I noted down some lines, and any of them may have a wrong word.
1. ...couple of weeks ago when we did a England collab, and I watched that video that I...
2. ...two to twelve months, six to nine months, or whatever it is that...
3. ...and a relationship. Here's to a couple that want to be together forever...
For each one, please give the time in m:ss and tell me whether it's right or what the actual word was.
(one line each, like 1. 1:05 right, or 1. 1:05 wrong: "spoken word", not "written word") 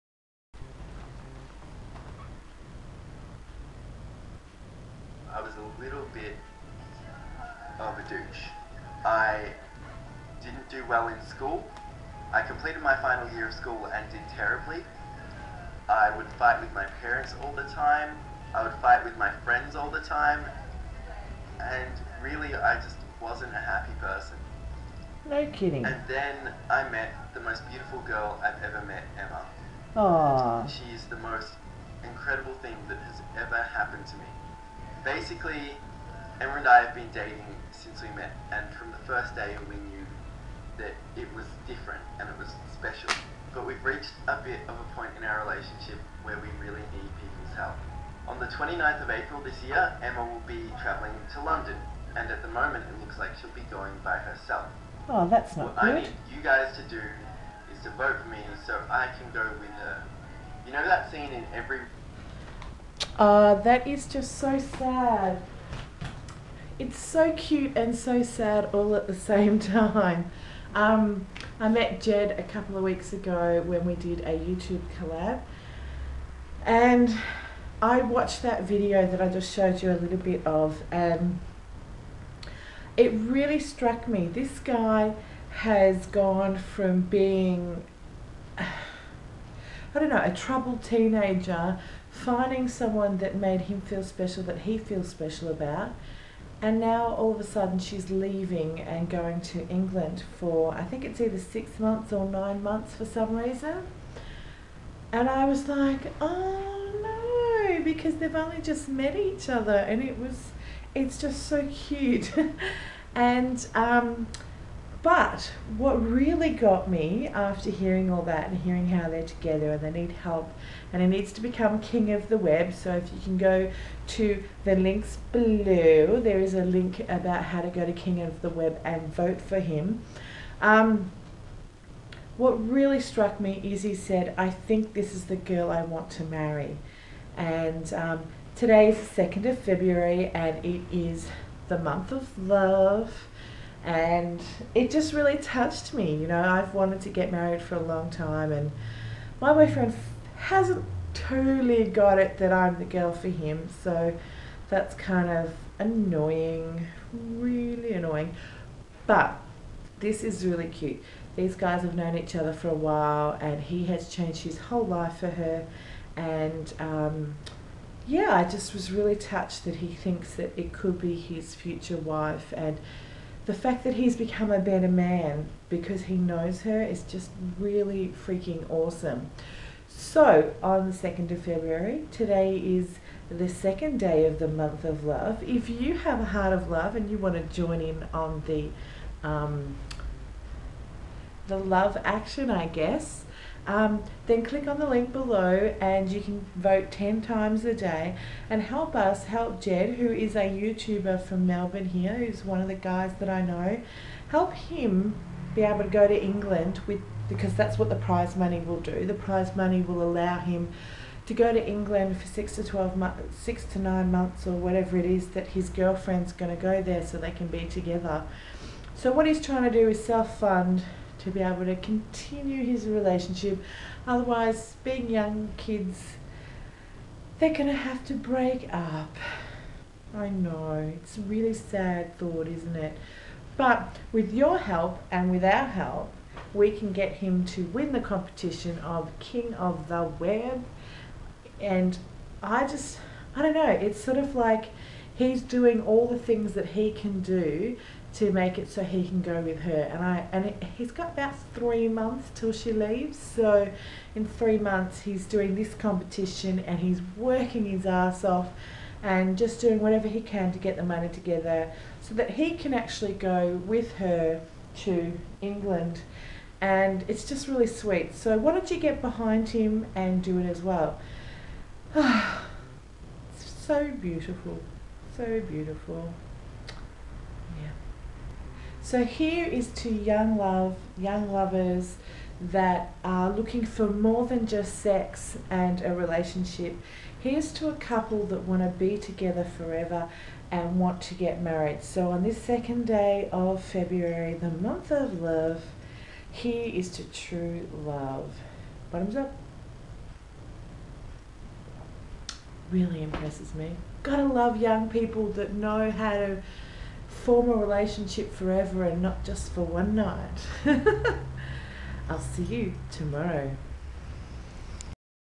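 1. 1:12 wrong: "YouTube", not "England"
2. 3:32 wrong: "six", not "two"
3. 4:45 right.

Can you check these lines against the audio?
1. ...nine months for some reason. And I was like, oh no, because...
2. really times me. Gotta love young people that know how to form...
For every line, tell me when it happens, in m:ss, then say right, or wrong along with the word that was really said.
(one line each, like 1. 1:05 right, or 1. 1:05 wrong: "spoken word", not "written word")
1. 1:42 right
2. 5:02 wrong: "impresses", not "times".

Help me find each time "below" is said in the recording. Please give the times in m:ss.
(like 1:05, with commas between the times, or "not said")
2:05, 3:15.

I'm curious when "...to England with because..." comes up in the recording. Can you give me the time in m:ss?
3:26.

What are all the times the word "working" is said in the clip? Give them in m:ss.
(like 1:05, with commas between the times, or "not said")
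4:17.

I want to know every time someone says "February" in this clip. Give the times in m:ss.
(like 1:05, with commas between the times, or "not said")
2:19, 3:01, 4:53.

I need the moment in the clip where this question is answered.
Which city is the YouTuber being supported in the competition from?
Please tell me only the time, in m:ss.
3:21.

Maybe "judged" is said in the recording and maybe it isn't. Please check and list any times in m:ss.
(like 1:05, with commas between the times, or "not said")
not said.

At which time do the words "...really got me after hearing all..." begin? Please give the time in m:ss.
1:55.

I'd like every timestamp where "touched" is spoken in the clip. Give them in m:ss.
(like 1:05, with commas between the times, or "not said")
2:25, 2:49.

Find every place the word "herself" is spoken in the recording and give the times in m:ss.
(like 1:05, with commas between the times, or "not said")
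0:54.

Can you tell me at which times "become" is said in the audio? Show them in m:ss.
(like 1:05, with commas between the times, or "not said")
2:01, 2:54.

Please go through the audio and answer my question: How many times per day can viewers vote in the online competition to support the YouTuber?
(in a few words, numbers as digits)
10.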